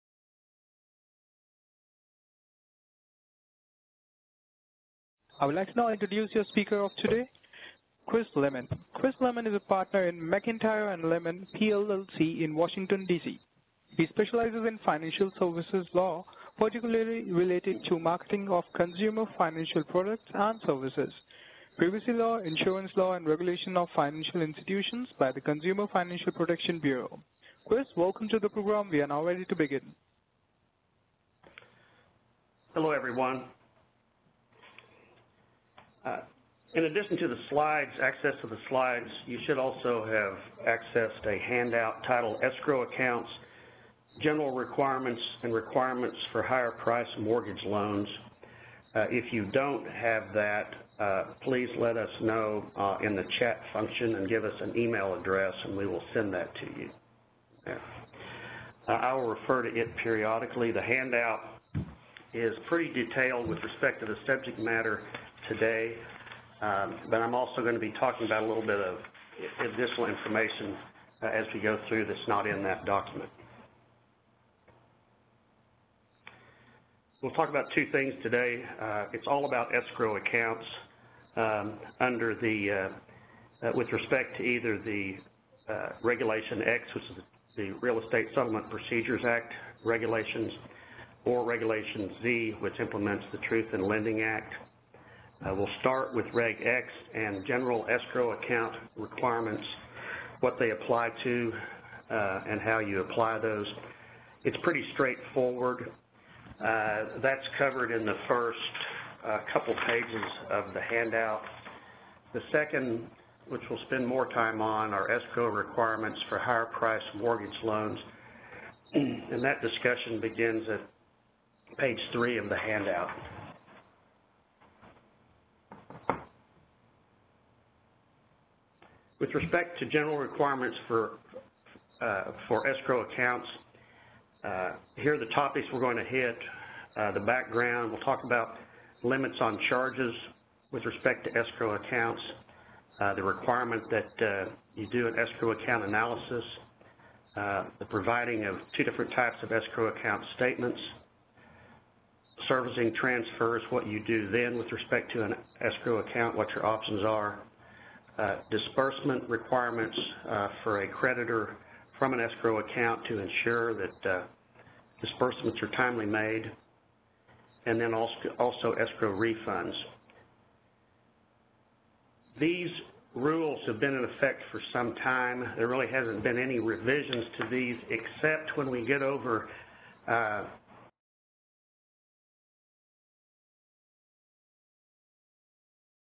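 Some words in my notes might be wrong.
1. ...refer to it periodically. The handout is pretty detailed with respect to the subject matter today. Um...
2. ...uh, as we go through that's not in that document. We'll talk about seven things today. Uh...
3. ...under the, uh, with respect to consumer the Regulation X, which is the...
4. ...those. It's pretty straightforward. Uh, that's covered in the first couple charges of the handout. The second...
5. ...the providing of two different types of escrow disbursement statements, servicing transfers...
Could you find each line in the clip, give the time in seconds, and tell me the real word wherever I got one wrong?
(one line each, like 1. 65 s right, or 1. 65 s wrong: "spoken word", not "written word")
1. 59 s right
2. 71 s wrong: "two", not "seven"
3. 81 s wrong: "either", not "consumer"
4. 103 s wrong: "pages", not "charges"
5. 147 s wrong: "account", not "disbursement".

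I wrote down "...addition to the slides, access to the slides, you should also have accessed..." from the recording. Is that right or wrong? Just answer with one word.
right.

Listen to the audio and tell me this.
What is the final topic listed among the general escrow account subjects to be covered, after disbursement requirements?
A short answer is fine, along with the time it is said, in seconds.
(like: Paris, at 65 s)
escrow refunds, at 168 s.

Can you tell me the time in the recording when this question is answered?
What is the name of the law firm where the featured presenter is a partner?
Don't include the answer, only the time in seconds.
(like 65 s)
10 s.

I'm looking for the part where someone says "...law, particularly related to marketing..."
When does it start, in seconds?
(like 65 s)
15 s.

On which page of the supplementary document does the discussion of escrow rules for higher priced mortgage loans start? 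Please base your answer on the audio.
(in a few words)
3.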